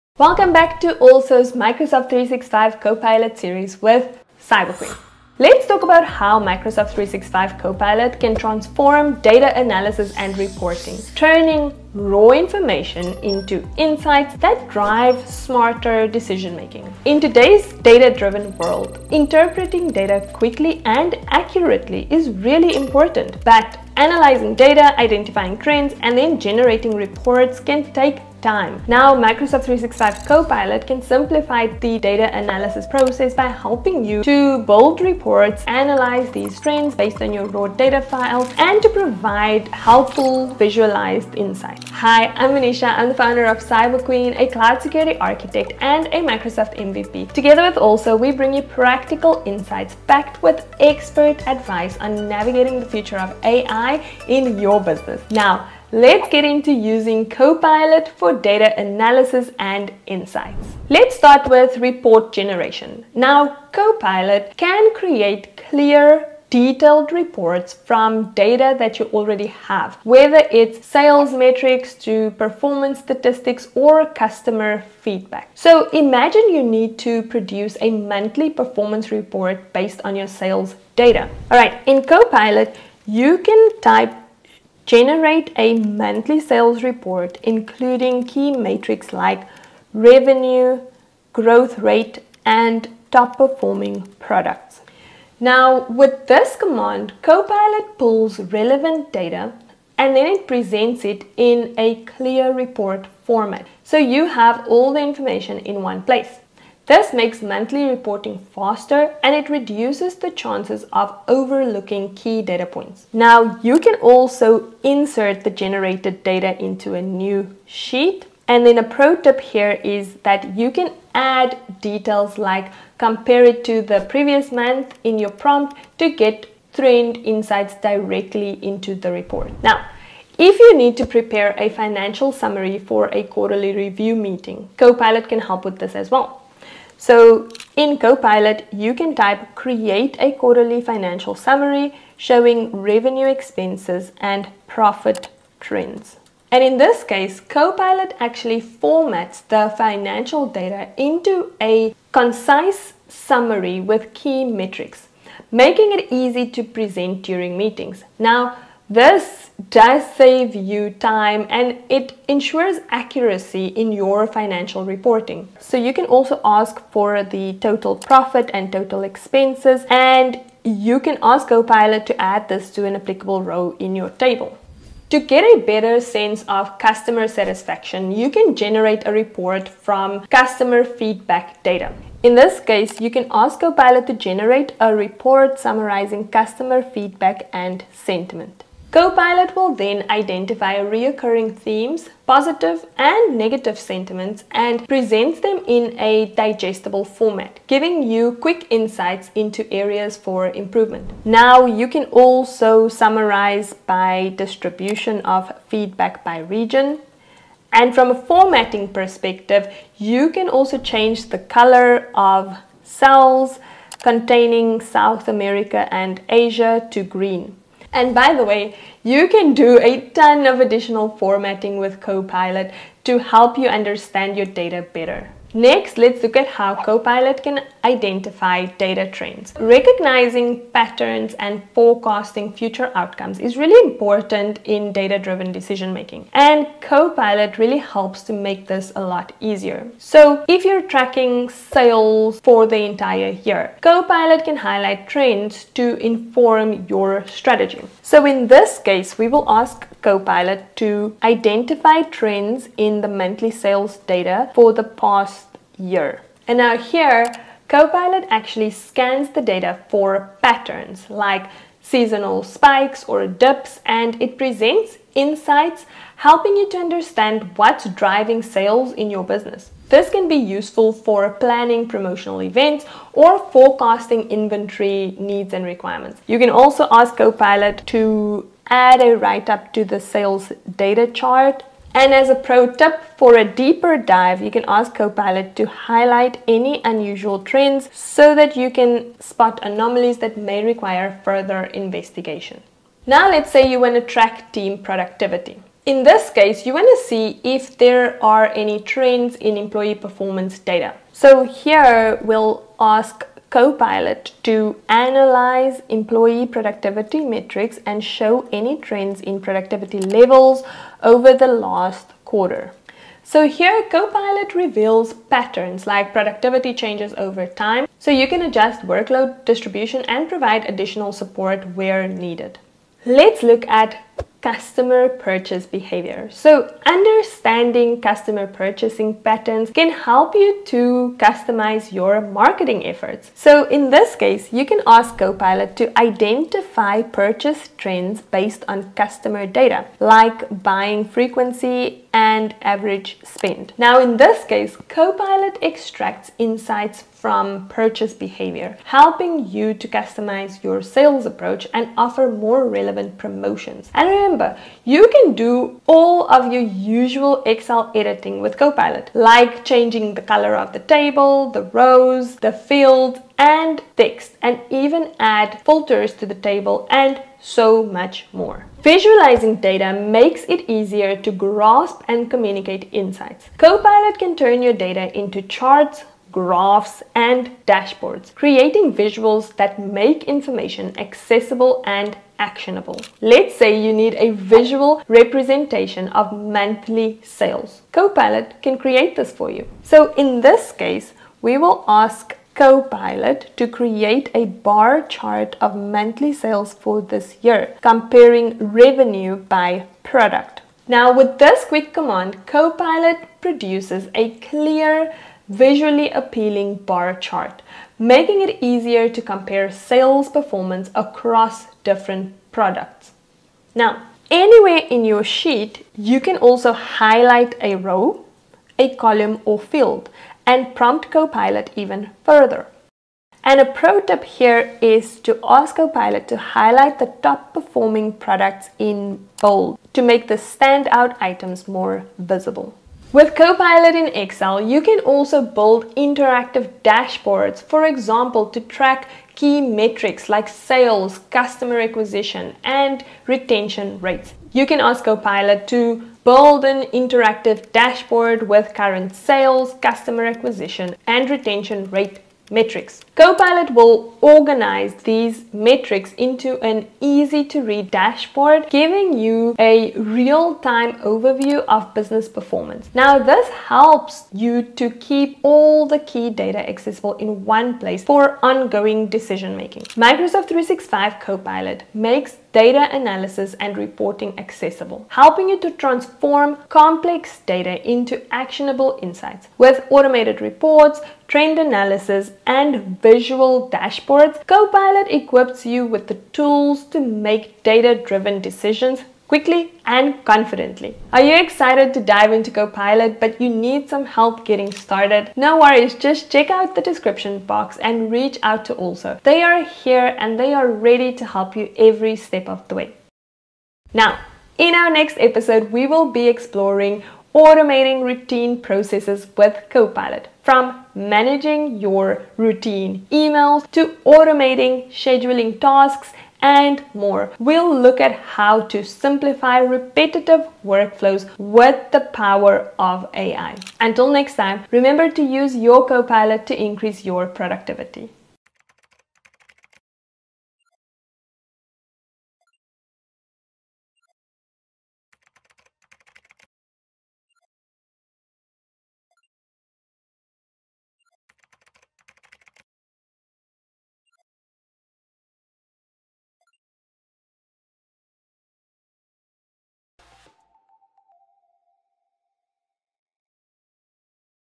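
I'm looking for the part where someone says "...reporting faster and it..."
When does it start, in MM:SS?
01:47.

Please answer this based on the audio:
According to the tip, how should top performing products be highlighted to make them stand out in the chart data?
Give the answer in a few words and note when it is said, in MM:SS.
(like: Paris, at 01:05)
in bold, at 07:08.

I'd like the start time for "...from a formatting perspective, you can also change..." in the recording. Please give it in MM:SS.
03:27.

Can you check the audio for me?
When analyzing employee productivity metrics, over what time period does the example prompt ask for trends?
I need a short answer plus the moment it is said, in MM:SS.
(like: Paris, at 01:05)
the last quarter, at 05:11.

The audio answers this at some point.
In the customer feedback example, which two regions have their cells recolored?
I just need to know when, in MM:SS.
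03:34.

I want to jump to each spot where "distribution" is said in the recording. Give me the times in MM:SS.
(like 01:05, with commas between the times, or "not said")
03:24, 05:19.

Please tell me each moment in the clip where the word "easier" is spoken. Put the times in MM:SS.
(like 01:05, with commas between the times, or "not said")
03:59, 06:10, 06:48.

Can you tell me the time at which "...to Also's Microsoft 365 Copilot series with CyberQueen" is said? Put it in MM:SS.
00:00.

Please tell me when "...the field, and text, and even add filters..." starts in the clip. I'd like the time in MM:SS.
06:02.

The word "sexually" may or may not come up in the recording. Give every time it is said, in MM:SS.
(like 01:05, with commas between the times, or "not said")
not said.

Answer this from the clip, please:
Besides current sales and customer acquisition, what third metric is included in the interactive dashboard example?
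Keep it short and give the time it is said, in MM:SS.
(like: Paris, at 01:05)
retention rate, at 07:31.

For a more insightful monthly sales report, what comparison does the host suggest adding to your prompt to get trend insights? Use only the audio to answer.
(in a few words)
compare it to the previous month.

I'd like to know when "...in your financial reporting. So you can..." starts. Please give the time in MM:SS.
02:43.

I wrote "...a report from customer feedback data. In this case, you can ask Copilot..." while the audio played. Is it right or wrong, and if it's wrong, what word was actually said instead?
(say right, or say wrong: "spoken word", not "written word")
right.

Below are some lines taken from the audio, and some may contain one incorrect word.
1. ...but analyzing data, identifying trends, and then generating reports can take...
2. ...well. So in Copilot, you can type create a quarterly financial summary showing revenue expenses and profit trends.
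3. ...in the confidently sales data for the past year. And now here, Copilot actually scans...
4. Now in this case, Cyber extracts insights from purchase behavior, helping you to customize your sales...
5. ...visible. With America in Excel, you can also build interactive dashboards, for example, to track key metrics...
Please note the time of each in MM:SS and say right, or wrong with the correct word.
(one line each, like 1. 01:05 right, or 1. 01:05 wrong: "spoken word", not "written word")
1. 00:23 right
2. 02:16 right
3. 04:12 wrong: "monthly", not "confidently"
4. 05:43 wrong: "Copilot", not "Cyber"
5. 07:12 wrong: "Copilot", not "America".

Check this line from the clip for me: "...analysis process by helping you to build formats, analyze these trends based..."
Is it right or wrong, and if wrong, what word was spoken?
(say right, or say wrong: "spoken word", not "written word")
wrong: "reports", not "formats".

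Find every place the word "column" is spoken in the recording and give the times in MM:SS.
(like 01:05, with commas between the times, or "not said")
06:58.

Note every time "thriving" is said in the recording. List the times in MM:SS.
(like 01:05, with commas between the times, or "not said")
not said.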